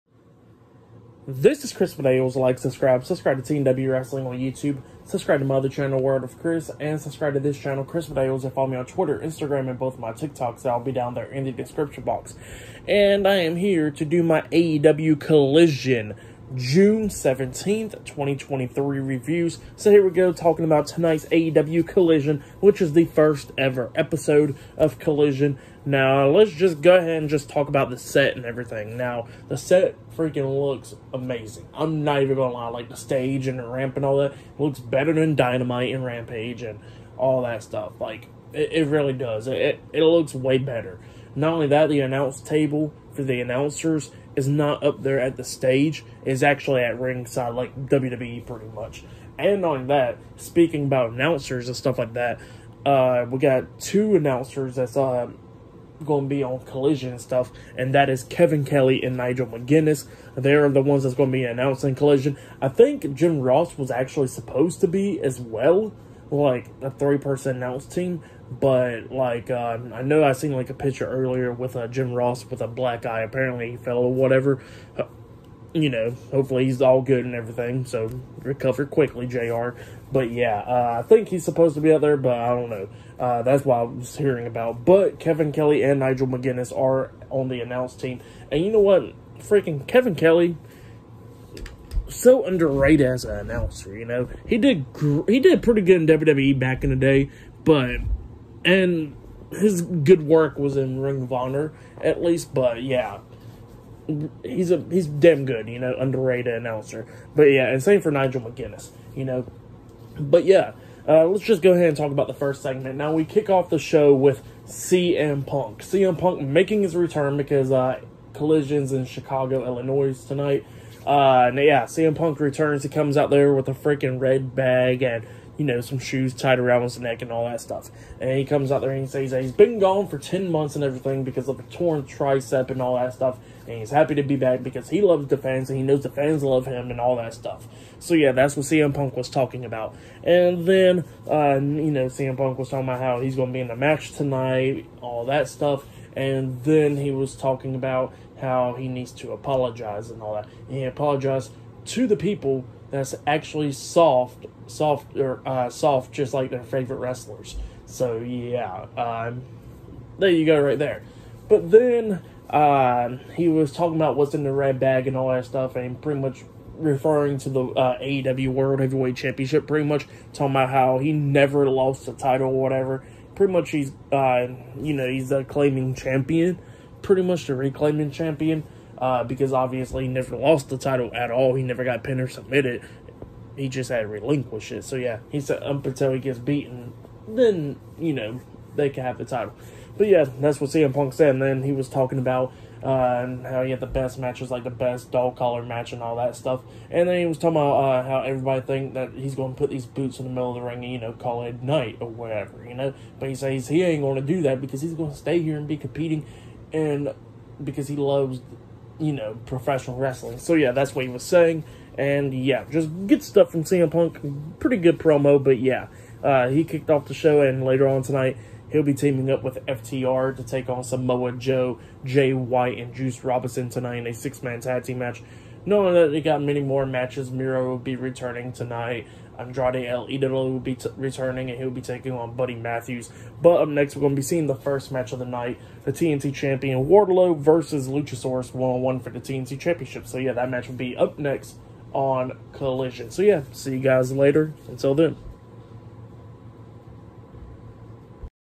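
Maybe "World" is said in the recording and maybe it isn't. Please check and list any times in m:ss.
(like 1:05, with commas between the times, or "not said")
0:06, 2:48.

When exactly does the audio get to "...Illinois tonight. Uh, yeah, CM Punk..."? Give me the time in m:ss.
1:59.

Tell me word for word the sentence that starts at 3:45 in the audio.
Knowing that they got many more matches, Miro will be returning tonight.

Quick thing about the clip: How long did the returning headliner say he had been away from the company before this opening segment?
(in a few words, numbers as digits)
10 months.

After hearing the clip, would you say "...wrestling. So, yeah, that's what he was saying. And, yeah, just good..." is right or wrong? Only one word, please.
right.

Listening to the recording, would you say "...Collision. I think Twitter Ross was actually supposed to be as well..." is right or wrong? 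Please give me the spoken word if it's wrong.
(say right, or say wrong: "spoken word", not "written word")
wrong: "Jim", not "Twitter".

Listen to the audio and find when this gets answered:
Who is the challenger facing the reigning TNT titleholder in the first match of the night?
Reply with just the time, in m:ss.
3:57.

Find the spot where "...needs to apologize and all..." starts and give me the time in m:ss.
2:28.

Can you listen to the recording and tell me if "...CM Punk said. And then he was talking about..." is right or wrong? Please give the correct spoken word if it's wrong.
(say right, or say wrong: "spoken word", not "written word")
right.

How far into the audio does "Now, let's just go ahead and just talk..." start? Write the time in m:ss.
0:25.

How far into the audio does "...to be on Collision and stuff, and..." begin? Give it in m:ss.
0:56.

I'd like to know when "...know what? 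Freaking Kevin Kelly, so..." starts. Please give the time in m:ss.
1:28.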